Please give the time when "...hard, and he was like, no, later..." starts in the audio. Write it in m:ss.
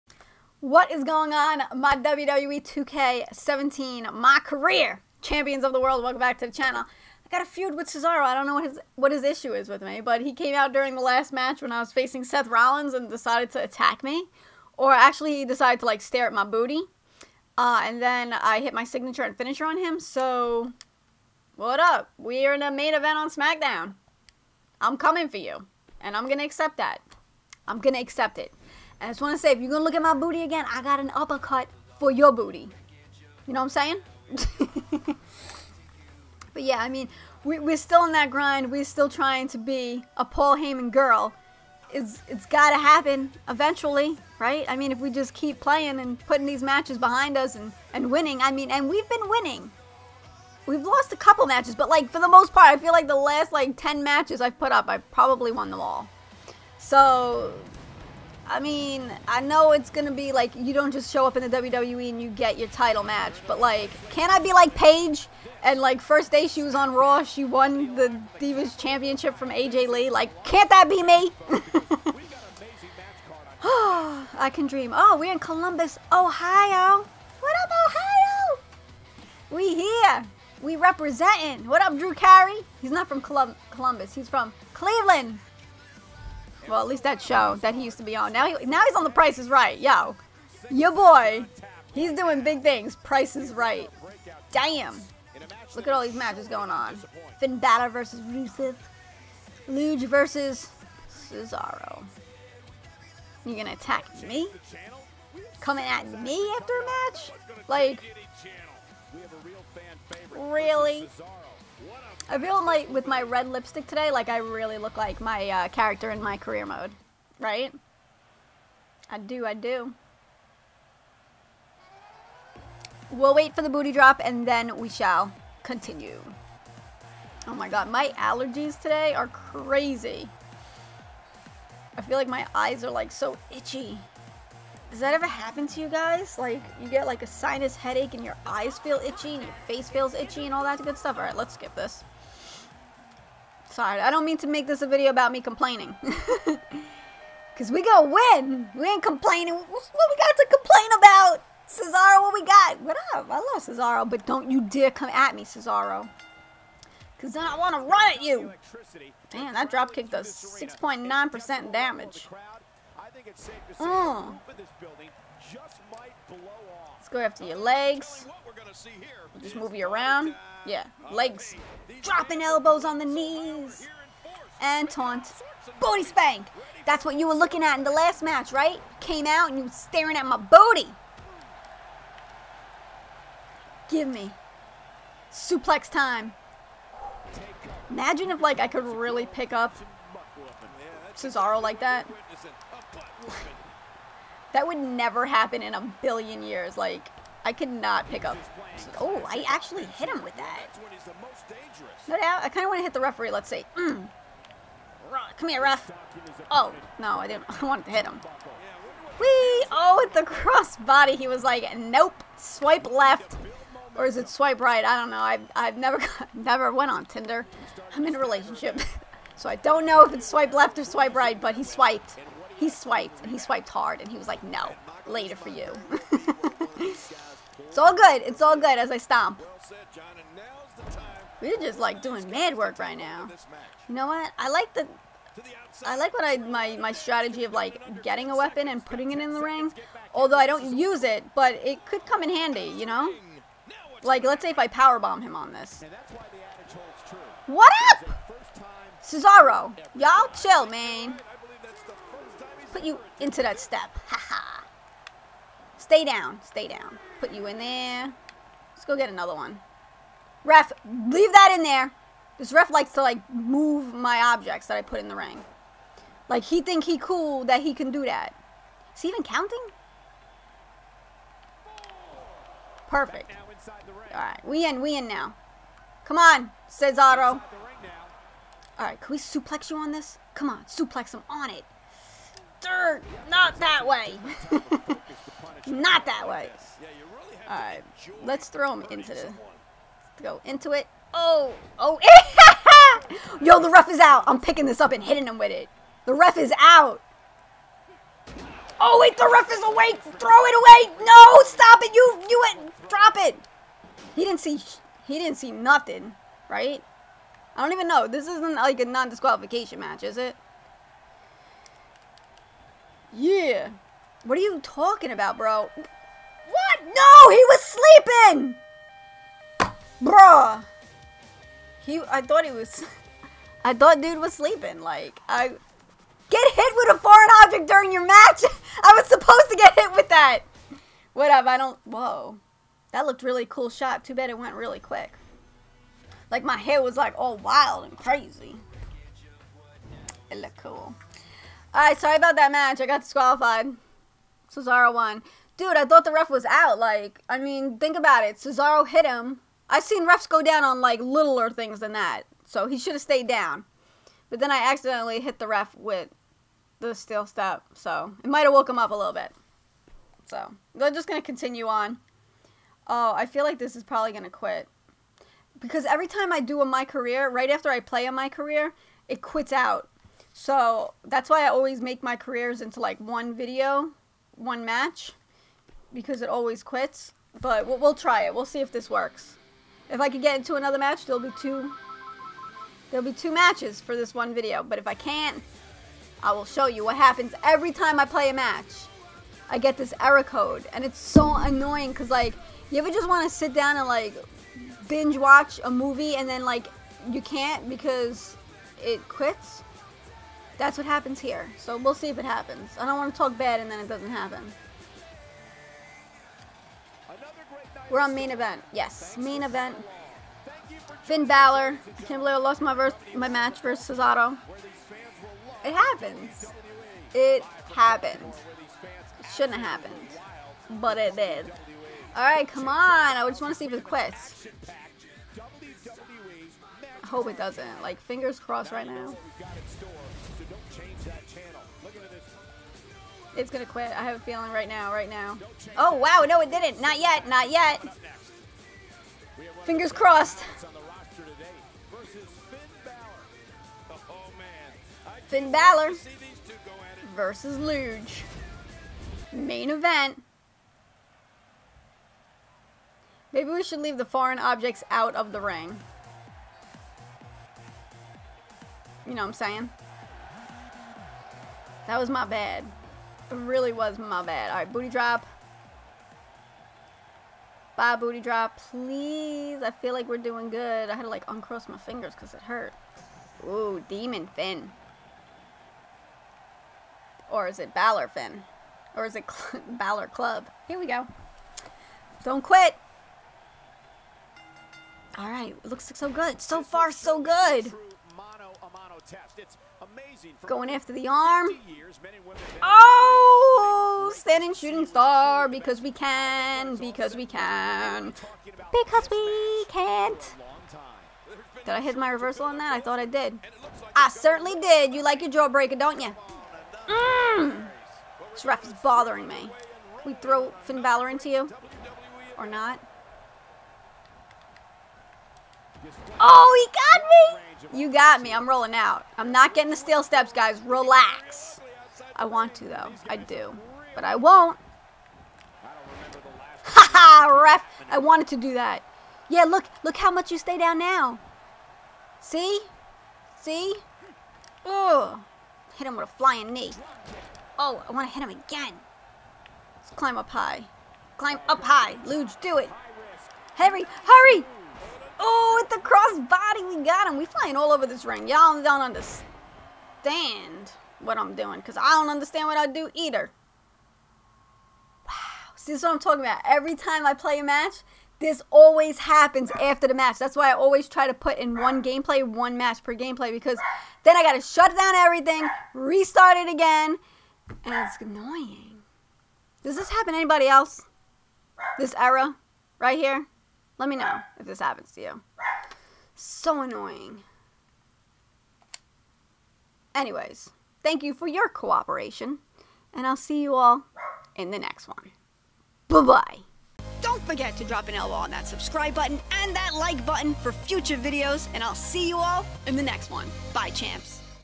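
3:43.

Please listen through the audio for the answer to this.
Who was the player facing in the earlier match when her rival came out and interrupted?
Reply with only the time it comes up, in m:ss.
0:12.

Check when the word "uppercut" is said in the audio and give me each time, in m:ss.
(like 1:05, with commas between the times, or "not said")
0:31.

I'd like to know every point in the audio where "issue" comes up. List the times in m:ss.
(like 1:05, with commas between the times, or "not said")
0:09.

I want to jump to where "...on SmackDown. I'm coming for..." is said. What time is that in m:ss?
0:23.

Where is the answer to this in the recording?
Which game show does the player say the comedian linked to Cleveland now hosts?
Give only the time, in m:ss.
1:29.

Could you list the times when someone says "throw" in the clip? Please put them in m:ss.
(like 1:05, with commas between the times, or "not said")
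4:48, 5:00, 8:30.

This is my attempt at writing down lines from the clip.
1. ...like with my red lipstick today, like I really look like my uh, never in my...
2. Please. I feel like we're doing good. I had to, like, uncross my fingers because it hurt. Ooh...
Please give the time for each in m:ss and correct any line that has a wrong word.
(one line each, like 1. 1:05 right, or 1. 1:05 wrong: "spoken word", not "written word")
1. 1:52 wrong: "character", not "never"
2. 7:48 right.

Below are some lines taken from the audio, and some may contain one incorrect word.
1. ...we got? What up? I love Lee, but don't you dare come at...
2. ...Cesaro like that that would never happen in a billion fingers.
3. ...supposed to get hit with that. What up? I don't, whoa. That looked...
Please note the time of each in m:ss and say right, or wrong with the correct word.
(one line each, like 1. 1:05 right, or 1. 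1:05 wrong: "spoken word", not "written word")
1. 2:32 wrong: "Cesaro", not "Lee"
2. 3:11 wrong: "years", not "fingers"
3. 5:29 right.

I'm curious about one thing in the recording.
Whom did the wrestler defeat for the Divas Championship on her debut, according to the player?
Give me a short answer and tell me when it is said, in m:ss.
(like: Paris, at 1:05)
AJ Lee, at 1:09.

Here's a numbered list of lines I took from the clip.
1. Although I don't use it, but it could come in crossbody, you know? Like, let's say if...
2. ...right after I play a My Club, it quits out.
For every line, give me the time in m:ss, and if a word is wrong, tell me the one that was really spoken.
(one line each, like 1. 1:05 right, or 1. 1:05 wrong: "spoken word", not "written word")
1. 4:00 wrong: "handy", not "crossbody"
2. 6:07 wrong: "Career", not "Club".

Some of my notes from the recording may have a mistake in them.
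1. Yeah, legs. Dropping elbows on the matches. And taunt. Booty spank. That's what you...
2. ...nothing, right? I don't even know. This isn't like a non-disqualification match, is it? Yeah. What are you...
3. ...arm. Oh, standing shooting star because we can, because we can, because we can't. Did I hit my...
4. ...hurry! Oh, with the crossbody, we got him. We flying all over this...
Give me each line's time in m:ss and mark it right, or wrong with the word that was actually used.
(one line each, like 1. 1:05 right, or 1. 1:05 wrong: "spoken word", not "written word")
1. 2:50 wrong: "knees", not "matches"
2. 5:05 right
3. 8:11 right
4. 9:04 right.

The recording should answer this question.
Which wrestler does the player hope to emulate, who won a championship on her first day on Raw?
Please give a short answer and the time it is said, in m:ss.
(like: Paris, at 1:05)
Paige, at 1:04.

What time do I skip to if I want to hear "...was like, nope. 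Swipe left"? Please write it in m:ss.
3:31.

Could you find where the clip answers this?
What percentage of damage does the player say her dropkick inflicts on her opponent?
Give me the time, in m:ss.
2:40.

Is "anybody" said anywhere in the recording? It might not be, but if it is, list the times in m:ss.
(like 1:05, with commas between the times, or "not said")
9:30.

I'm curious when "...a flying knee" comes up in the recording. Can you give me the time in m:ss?
8:56.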